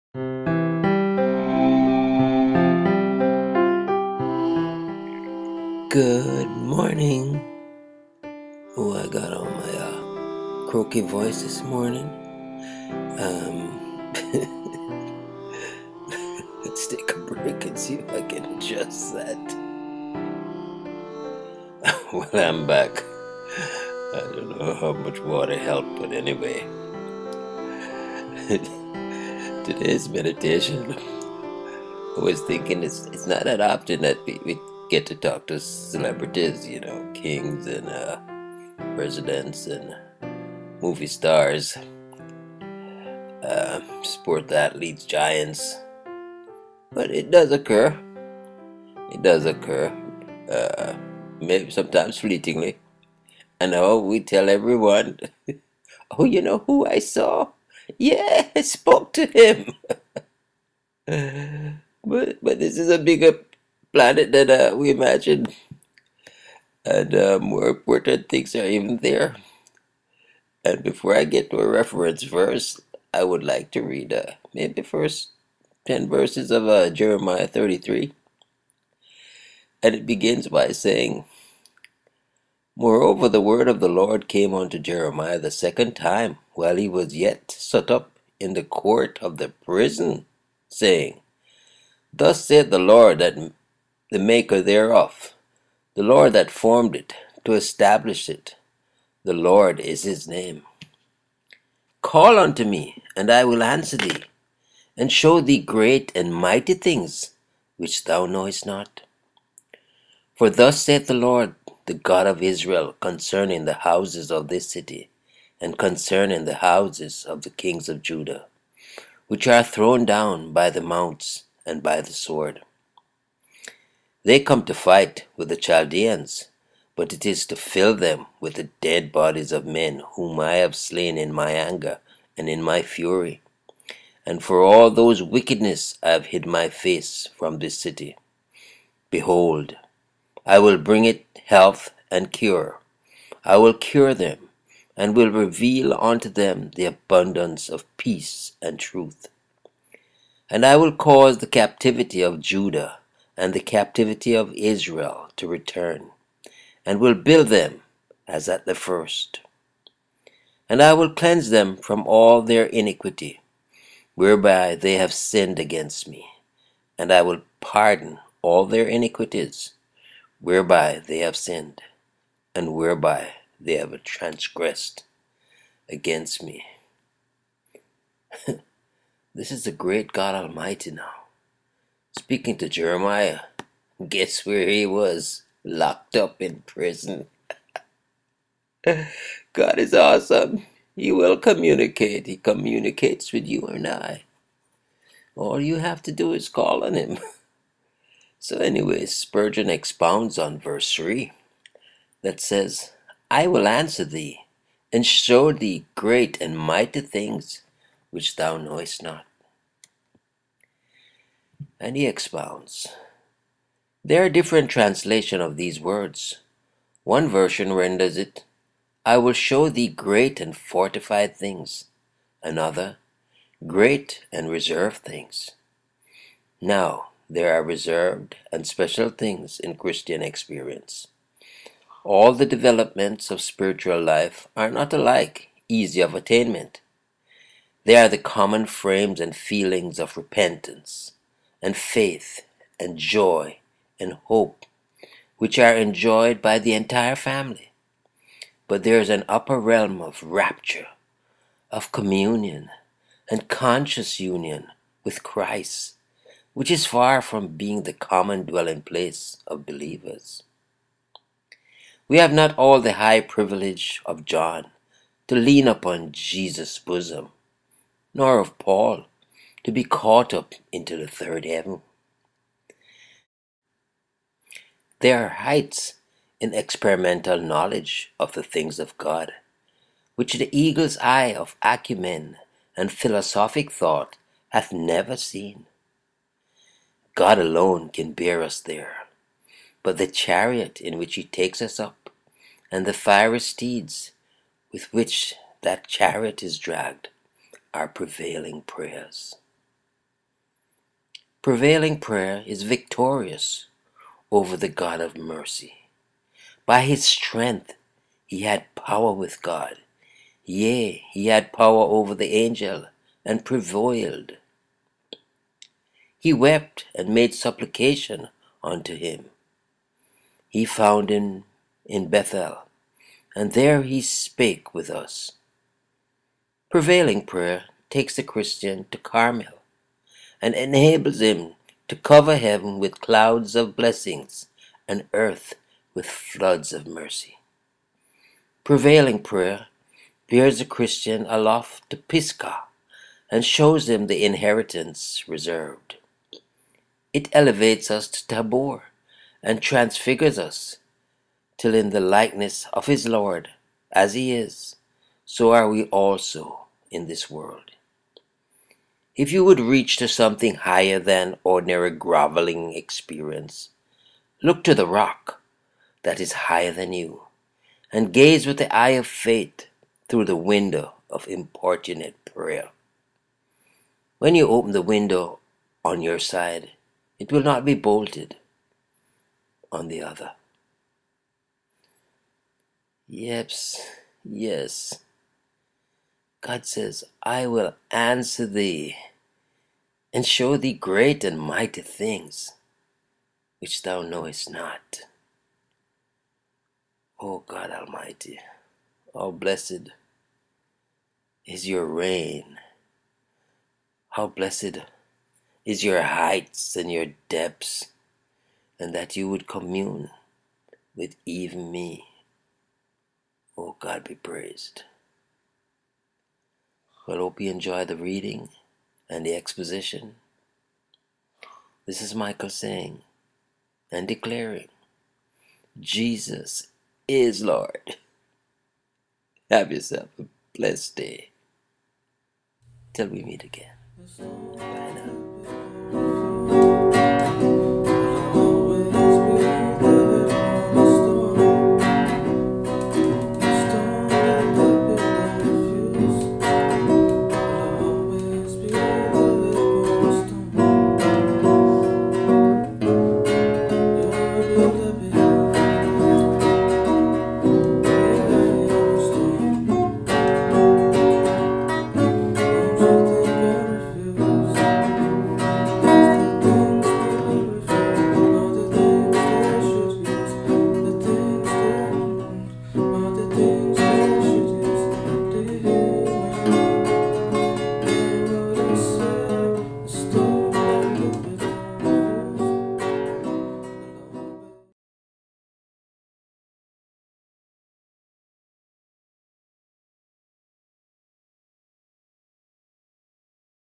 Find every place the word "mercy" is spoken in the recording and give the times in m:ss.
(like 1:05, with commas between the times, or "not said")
5:05, 5:36.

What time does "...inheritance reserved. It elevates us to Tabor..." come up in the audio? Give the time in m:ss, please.
5:44.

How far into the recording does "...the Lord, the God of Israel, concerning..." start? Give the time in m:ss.
1:51.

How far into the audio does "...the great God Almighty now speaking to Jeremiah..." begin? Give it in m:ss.
2:59.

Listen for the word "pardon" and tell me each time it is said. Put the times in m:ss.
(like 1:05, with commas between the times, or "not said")
2:47.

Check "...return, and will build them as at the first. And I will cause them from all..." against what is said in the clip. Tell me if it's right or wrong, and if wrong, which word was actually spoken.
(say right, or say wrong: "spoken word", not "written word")
wrong: "cleanse", not "cause".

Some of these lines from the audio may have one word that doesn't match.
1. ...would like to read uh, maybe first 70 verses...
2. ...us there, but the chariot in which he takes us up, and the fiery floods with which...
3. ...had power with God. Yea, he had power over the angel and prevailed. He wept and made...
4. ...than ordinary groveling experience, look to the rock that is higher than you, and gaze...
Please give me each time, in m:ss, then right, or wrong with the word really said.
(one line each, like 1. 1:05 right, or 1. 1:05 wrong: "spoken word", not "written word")
1. 1:13 wrong: "10", not "70"
2. 4:48 wrong: "steeds", not "floods"
3. 5:08 right
4. 6:00 right.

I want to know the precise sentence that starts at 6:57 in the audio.
But hope you enjoy the reading and the exposition.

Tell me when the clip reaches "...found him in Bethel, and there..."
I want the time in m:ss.
5:20.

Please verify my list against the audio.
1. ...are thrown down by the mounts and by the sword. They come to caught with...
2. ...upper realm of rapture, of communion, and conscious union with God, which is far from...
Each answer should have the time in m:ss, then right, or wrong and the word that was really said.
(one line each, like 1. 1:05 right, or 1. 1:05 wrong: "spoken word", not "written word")
1. 1:59 wrong: "fight", not "caught"
2. 4:09 wrong: "Christ", not "God".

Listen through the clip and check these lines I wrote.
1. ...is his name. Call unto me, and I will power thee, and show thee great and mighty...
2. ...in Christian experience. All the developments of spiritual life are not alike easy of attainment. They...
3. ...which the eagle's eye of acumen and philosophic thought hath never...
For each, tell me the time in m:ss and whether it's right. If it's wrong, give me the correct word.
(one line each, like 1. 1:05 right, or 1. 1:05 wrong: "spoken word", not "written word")
1. 1:39 wrong: "answer", not "power"
2. 3:49 right
3. 4:40 right.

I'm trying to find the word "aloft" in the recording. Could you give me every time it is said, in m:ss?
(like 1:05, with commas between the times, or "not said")
5:41.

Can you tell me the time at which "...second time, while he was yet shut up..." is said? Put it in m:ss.
1:25.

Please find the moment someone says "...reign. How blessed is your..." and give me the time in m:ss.
6:41.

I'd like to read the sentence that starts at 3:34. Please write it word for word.
There are different translations of these words.